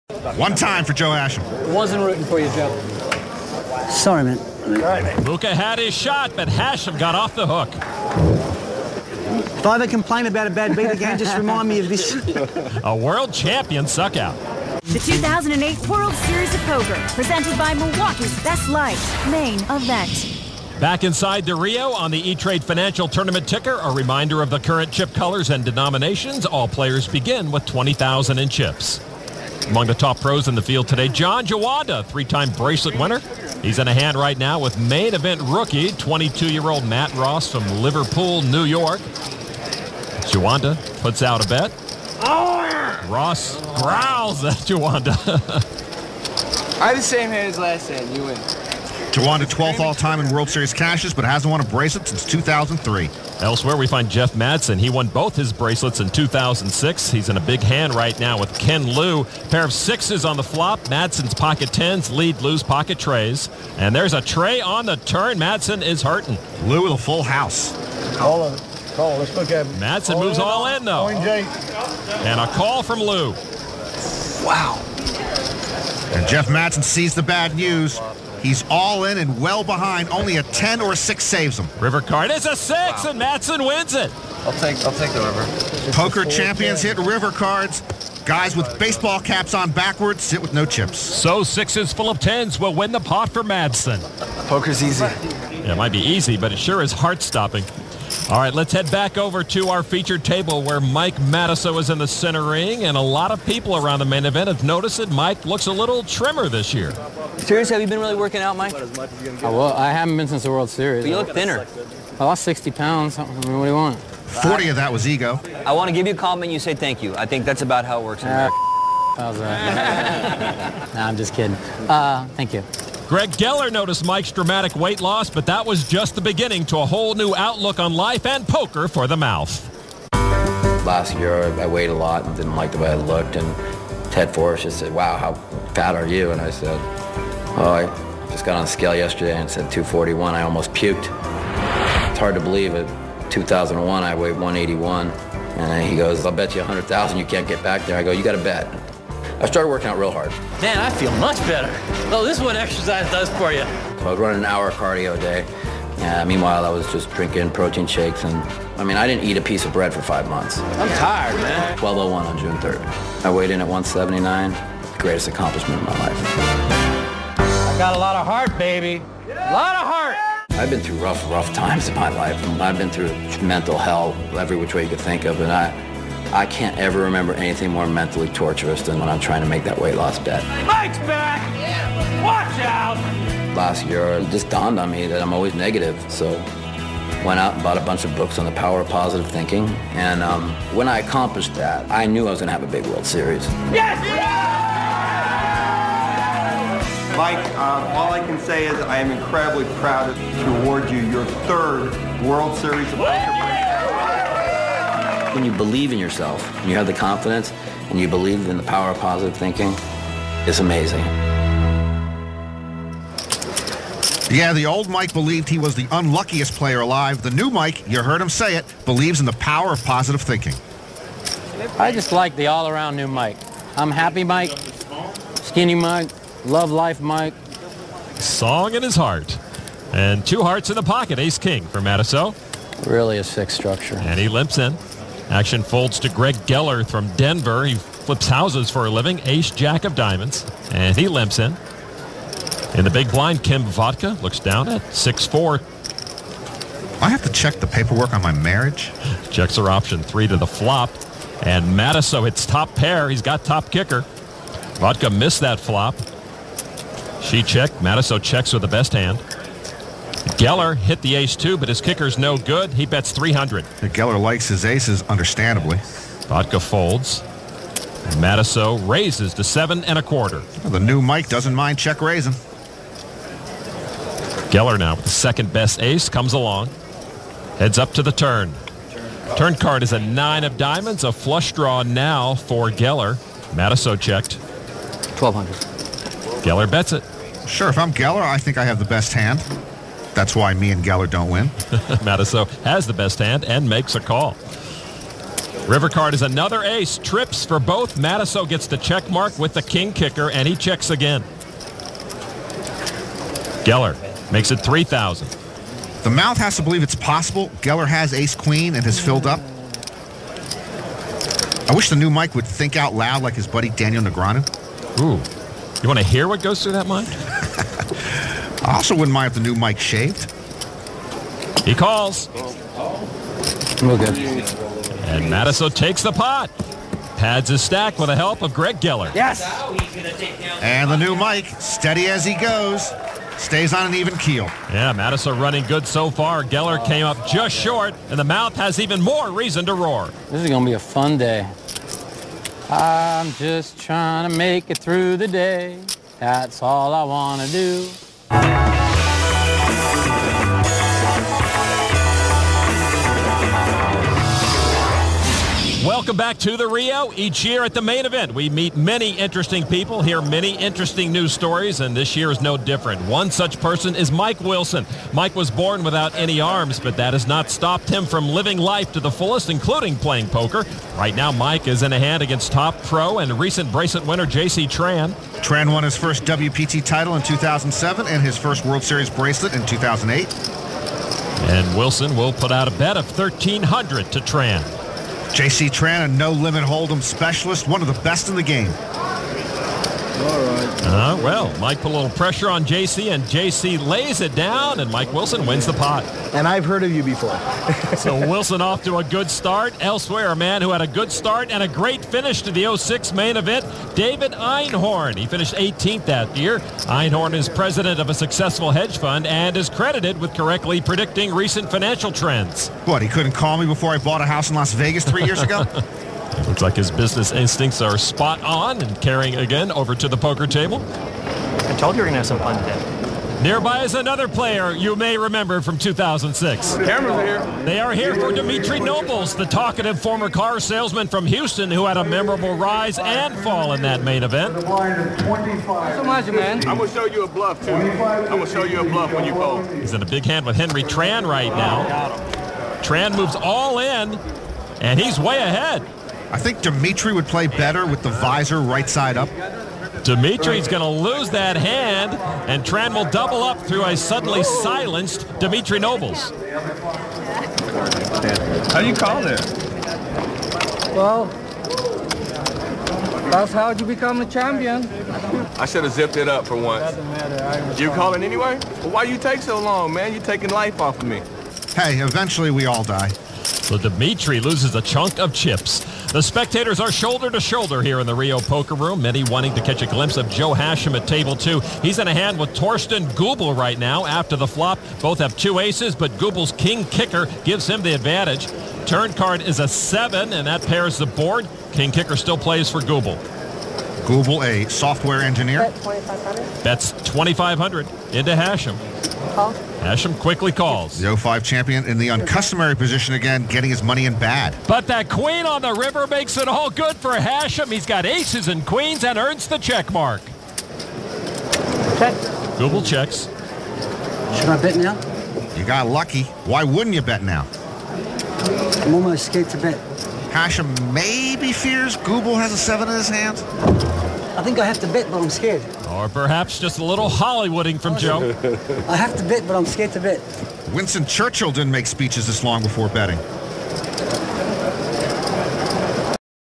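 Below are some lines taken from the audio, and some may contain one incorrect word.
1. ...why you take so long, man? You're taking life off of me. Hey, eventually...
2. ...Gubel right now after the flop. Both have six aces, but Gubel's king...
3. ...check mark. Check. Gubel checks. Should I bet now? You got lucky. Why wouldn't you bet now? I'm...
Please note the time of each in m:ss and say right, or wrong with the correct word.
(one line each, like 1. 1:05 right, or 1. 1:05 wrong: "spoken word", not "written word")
1. 7:48 right
2. 8:03 wrong: "two", not "six"
3. 8:29 right.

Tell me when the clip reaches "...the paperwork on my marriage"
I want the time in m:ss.
4:07.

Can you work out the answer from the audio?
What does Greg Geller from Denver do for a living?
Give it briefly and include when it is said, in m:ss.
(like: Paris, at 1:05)
Flips houses, at 3:57.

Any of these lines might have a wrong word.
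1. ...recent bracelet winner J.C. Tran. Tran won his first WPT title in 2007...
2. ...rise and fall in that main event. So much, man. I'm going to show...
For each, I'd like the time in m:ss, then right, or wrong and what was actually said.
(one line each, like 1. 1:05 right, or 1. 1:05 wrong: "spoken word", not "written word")
1. 6:13 right
2. 7:12 right.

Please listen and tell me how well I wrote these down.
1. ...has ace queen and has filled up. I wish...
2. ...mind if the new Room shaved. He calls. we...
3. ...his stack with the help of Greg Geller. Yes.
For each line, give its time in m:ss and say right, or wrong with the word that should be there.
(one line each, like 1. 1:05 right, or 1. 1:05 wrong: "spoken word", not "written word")
1. 5:07 right
2. 5:19 wrong: "Mike", not "Room"
3. 5:27 right.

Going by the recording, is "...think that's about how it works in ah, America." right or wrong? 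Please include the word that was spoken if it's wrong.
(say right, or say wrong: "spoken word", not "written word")
right.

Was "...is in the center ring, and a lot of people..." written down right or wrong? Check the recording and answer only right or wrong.
right.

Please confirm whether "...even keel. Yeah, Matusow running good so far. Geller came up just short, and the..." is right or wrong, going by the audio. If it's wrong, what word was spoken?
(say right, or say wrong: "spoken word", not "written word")
right.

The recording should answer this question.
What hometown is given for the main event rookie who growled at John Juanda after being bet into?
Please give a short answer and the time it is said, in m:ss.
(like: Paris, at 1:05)
Liverpool, New York, at 0:37.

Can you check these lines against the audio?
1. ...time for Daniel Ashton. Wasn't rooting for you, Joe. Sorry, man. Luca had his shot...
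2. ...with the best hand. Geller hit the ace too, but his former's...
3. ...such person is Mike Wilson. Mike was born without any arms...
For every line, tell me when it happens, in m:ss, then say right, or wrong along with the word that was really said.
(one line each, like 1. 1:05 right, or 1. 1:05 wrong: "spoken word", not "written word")
1. 0:00 wrong: "Joe", not "Daniel"
2. 4:18 wrong: "kicker", not "former"
3. 6:03 right.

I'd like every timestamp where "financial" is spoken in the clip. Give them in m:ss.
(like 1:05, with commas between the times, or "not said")
0:22, 6:51.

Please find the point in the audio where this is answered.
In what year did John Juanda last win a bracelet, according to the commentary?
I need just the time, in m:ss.
0:52.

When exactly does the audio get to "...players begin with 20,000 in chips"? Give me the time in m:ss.
0:26.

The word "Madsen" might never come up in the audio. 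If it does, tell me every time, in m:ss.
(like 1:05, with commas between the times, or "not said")
0:54, 1:00, 1:05, 1:09, 1:16, 1:23, 1:33.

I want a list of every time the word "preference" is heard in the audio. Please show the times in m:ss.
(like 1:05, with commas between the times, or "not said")
not said.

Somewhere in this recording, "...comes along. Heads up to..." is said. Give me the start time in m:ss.
4:36.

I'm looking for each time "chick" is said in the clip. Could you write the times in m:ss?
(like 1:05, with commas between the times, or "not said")
not said.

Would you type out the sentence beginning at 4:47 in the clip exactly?
Sure, if I'm Geller, I think I have the best hand.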